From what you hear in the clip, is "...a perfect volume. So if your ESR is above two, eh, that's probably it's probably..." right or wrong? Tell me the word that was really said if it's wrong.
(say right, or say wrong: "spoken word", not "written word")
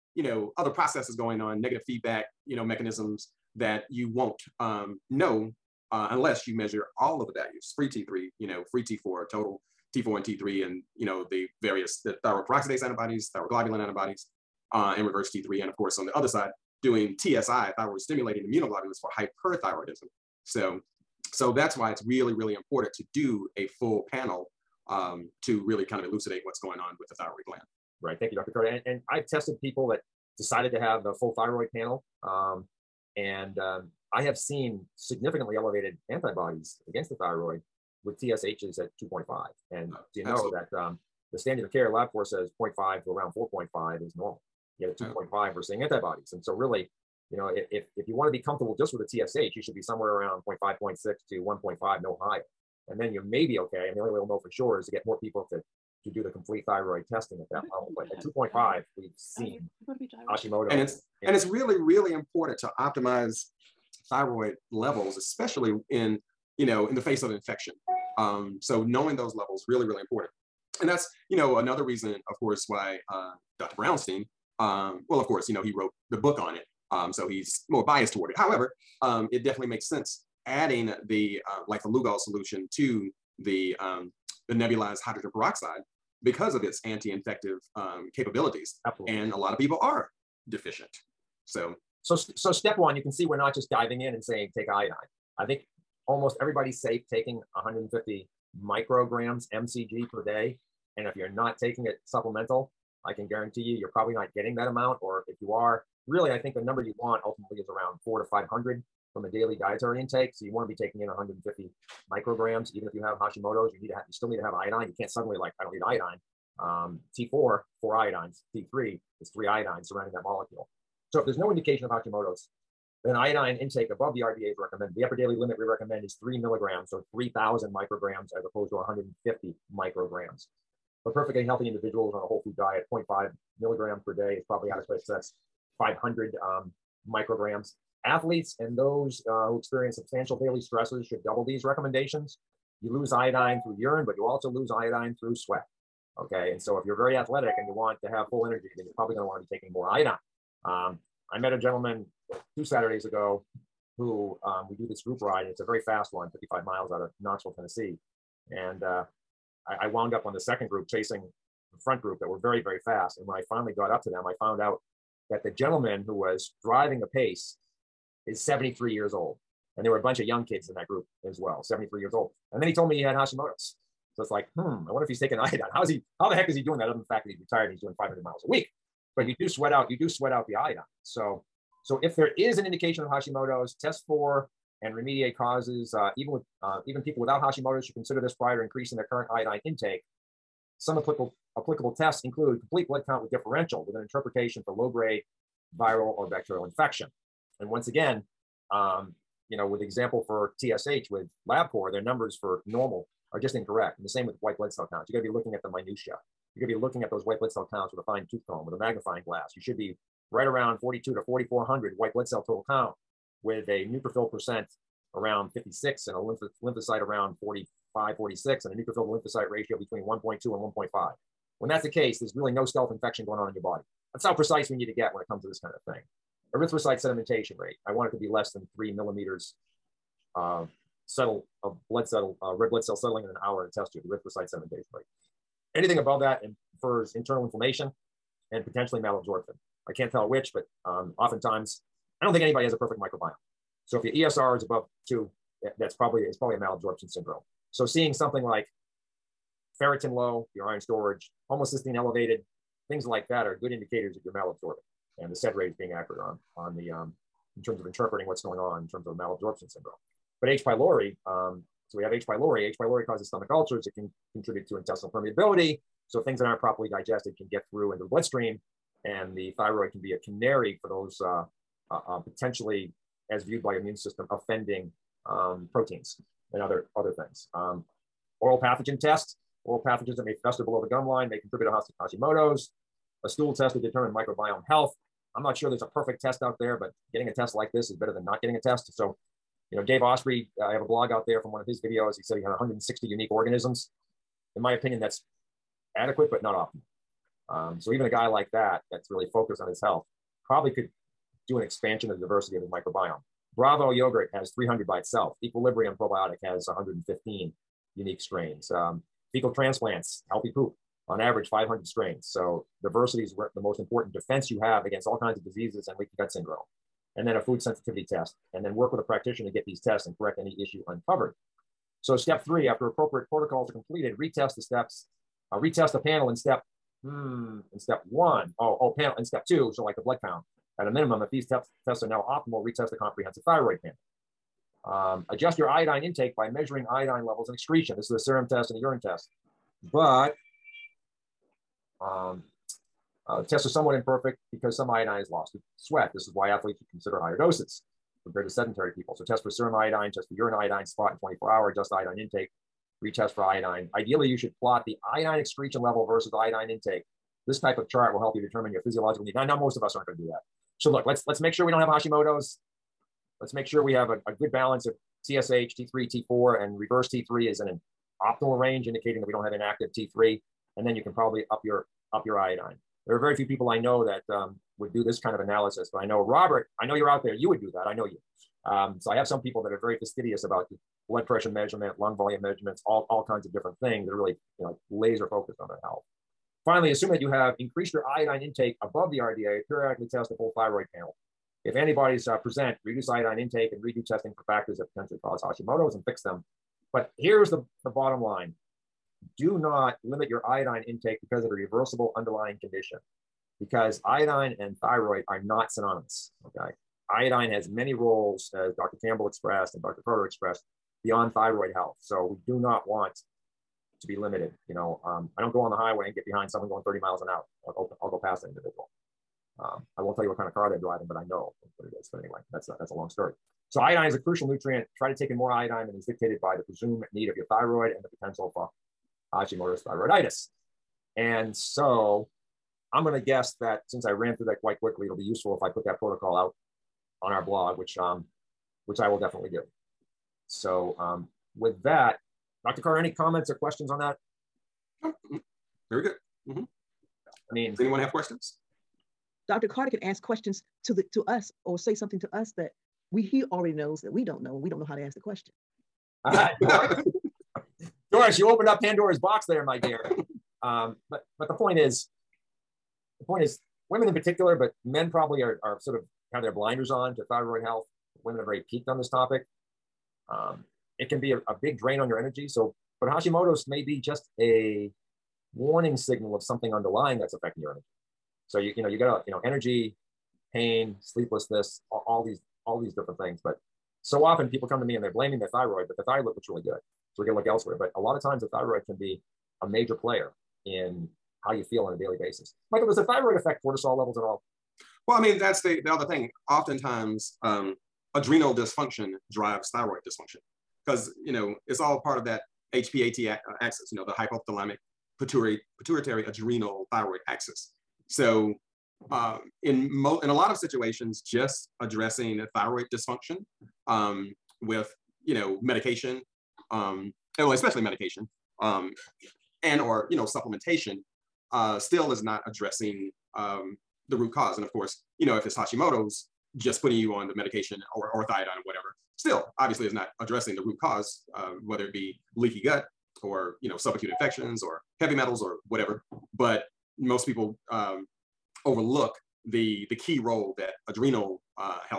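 wrong: "microbiome", not "volume".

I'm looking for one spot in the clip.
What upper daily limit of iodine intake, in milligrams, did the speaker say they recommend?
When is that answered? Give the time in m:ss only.
2:06.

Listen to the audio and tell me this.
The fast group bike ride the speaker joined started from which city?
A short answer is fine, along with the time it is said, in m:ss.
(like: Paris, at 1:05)
Knoxville, Tennessee, at 2:37.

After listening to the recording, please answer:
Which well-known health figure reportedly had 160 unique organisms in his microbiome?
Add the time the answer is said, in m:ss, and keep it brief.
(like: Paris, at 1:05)
Dave Asprey, at 4:49.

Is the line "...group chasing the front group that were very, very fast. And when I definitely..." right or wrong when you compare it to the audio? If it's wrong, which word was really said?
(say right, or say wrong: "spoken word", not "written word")
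wrong: "finally", not "definitely".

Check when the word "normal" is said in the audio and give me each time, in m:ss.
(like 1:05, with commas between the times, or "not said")
0:44, 3:22.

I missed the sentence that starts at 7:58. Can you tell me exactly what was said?
So you you know you got a you know energy, pain, sleeplessness, all, all these all these different things.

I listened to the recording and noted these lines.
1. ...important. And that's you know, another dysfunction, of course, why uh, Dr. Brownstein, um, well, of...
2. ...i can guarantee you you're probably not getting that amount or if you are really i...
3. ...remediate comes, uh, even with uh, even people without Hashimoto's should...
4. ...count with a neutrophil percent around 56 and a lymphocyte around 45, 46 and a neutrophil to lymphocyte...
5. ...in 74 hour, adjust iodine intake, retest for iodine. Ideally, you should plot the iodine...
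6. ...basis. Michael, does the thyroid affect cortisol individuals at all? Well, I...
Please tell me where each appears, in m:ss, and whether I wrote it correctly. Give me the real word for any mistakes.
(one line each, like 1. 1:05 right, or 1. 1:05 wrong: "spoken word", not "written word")
1. 1:10 wrong: "reason", not "dysfunction"
2. 1:43 right
3. 3:04 wrong: "causes", not "comes"
4. 3:32 right
5. 5:51 wrong: "24", not "74"
6. 8:12 wrong: "levels", not "individuals".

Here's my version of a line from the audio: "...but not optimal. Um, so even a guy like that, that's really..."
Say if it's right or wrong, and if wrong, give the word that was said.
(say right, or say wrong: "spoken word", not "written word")
right.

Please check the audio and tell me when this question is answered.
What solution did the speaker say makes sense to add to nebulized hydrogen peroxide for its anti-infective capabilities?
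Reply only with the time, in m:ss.
1:21.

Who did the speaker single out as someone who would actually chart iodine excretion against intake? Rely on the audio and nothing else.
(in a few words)
Robert.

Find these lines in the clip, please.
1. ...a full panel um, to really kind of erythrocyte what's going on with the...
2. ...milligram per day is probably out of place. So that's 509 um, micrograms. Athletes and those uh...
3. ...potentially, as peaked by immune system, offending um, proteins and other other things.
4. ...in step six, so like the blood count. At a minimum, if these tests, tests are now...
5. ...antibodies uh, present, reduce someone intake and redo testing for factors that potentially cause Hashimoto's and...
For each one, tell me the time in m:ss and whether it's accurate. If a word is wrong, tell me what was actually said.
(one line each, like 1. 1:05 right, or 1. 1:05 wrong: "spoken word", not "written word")
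1. 0:23 wrong: "elucidate", not "erythrocyte"
2. 2:13 wrong: "500", not "509"
3. 4:32 wrong: "viewed", not "peaked"
4. 5:29 wrong: "two", not "six"
5. 6:31 wrong: "iodine", not "someone".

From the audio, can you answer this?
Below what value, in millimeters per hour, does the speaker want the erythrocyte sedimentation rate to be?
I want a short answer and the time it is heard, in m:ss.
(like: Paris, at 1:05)
3, at 3:48.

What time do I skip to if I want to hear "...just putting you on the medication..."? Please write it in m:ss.
8:46.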